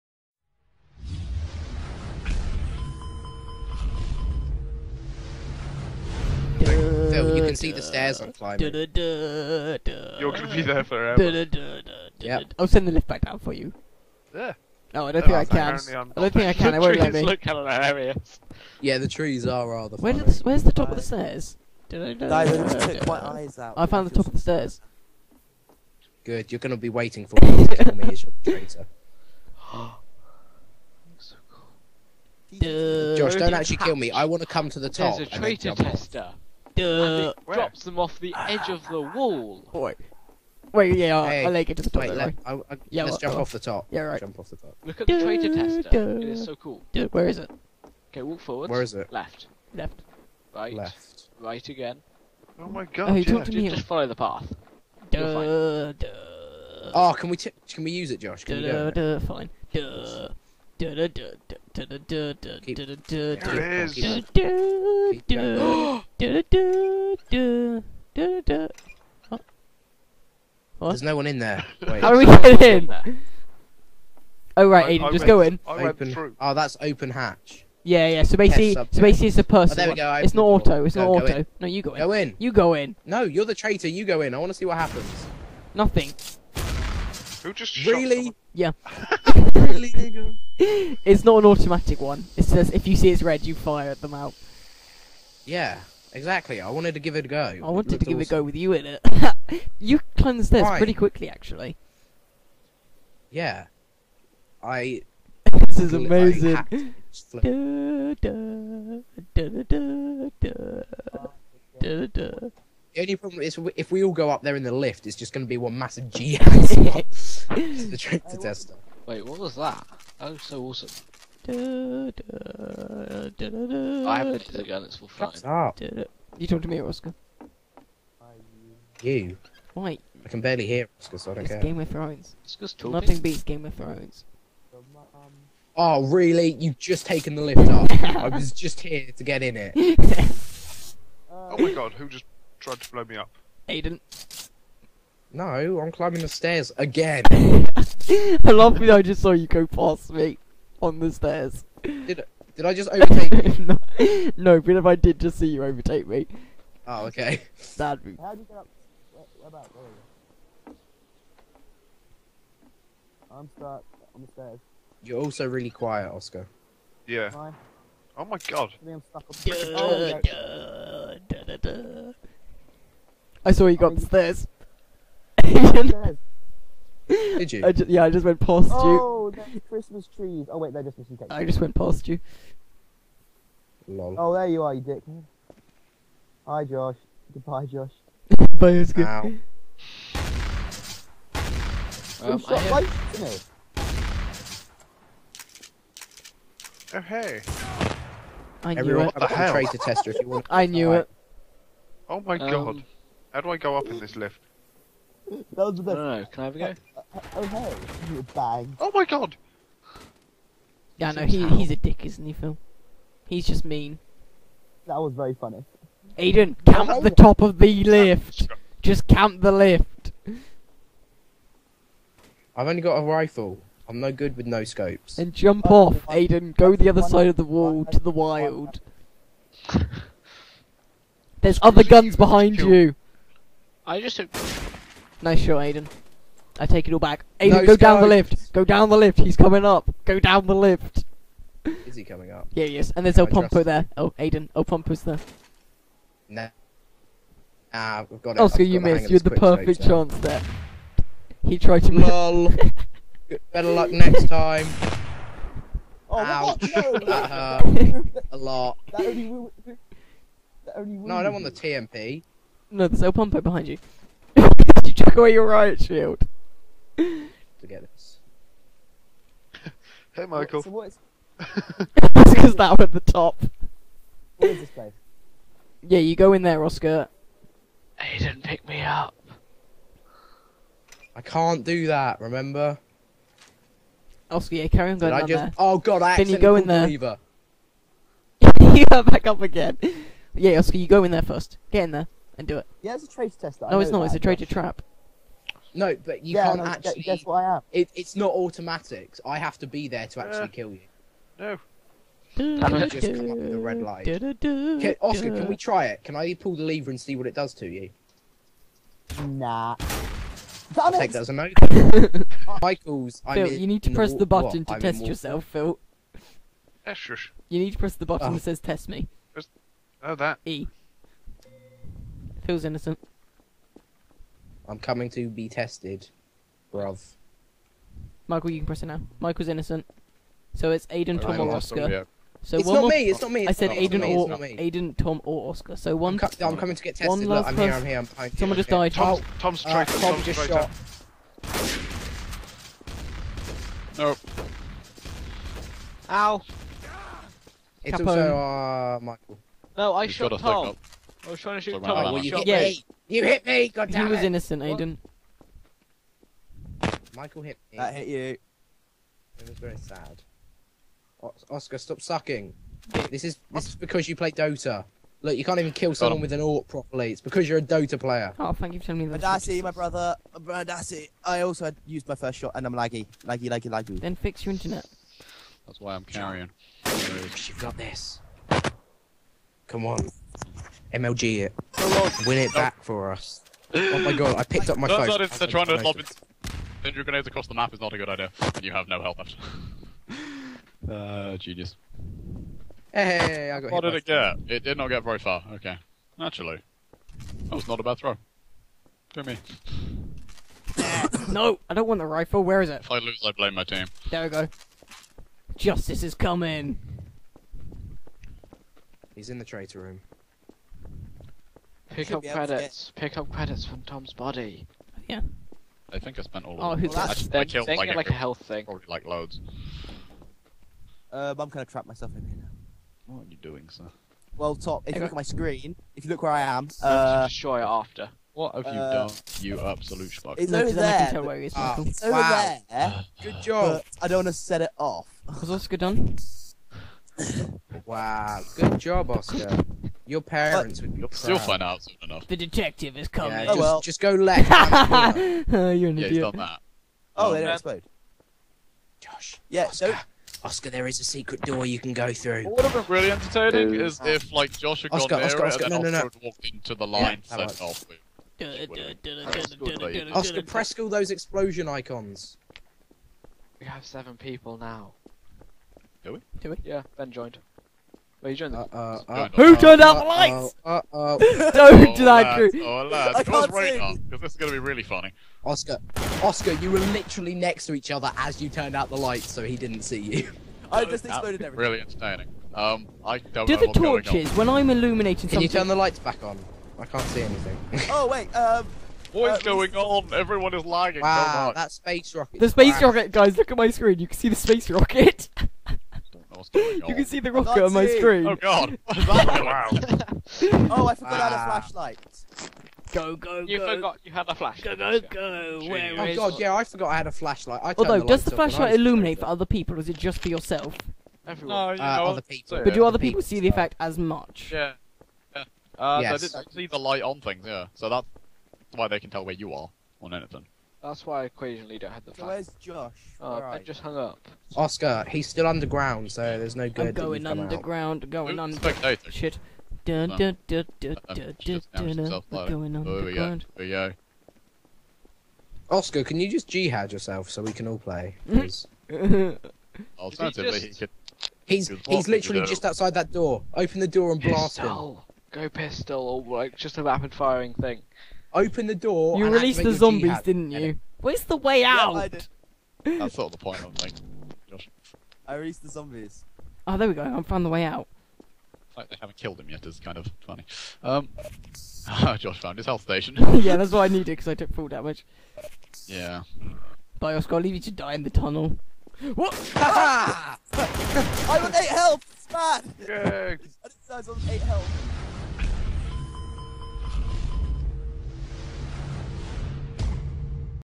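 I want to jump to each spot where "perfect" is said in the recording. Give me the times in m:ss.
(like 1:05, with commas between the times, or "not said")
4:09.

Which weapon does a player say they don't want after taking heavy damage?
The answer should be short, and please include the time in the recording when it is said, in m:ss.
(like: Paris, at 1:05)
TMP, at 4:21.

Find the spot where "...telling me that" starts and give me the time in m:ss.
6:08.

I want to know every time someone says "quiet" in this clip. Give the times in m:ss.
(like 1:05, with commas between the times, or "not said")
2:45.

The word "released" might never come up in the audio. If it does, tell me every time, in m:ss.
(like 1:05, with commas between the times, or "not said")
9:09, 9:15.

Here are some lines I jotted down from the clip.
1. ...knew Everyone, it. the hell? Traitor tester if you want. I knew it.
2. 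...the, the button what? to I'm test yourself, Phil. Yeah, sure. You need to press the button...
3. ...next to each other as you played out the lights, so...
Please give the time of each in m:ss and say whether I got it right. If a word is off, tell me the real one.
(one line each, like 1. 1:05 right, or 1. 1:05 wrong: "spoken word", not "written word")
1. 3:18 right
2. 5:14 right
3. 7:57 wrong: "turned", not "played".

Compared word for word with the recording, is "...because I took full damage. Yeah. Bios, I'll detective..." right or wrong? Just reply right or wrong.
wrong.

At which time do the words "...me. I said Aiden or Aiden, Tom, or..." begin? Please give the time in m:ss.
5:33.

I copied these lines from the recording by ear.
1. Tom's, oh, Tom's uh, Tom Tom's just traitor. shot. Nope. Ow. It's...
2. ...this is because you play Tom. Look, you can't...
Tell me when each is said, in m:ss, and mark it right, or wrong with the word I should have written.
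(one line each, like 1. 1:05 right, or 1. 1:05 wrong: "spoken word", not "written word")
1. 5:38 right
2. 6:03 wrong: "Dota", not "Tom".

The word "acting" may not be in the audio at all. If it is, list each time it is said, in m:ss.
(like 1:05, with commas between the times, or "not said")
not said.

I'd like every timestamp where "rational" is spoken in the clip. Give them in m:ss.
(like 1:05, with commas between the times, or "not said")
not said.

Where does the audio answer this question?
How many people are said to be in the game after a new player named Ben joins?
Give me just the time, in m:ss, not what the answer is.
7:43.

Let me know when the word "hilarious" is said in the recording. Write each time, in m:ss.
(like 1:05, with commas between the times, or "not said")
0:17.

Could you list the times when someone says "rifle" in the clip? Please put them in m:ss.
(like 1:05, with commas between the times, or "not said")
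3:43, 6:42.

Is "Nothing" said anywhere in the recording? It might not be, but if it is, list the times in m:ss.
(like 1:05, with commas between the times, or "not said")
1:25, 2:12.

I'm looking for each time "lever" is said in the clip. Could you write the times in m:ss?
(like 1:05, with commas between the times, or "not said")
5:06.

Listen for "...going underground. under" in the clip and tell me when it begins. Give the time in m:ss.
8:48.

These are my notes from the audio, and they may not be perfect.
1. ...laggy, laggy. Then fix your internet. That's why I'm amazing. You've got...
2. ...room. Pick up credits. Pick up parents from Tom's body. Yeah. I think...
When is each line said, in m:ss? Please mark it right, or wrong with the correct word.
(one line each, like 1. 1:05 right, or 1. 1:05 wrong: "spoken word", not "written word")
1. 6:13 wrong: "carrying", not "amazing"
2. 6:49 wrong: "credits", not "parents".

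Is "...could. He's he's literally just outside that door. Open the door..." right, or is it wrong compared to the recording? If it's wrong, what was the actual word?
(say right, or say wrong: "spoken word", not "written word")
right.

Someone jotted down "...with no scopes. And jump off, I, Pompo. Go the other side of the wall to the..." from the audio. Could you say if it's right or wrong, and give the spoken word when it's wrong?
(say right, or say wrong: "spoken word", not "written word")
wrong: "Aiden", not "Pompo".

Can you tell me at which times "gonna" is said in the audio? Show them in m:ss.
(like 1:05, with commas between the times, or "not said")
0:10, 0:26, 7:01.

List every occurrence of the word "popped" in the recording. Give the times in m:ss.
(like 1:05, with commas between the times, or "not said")
not said.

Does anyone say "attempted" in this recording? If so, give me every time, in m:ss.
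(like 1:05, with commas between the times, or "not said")
not said.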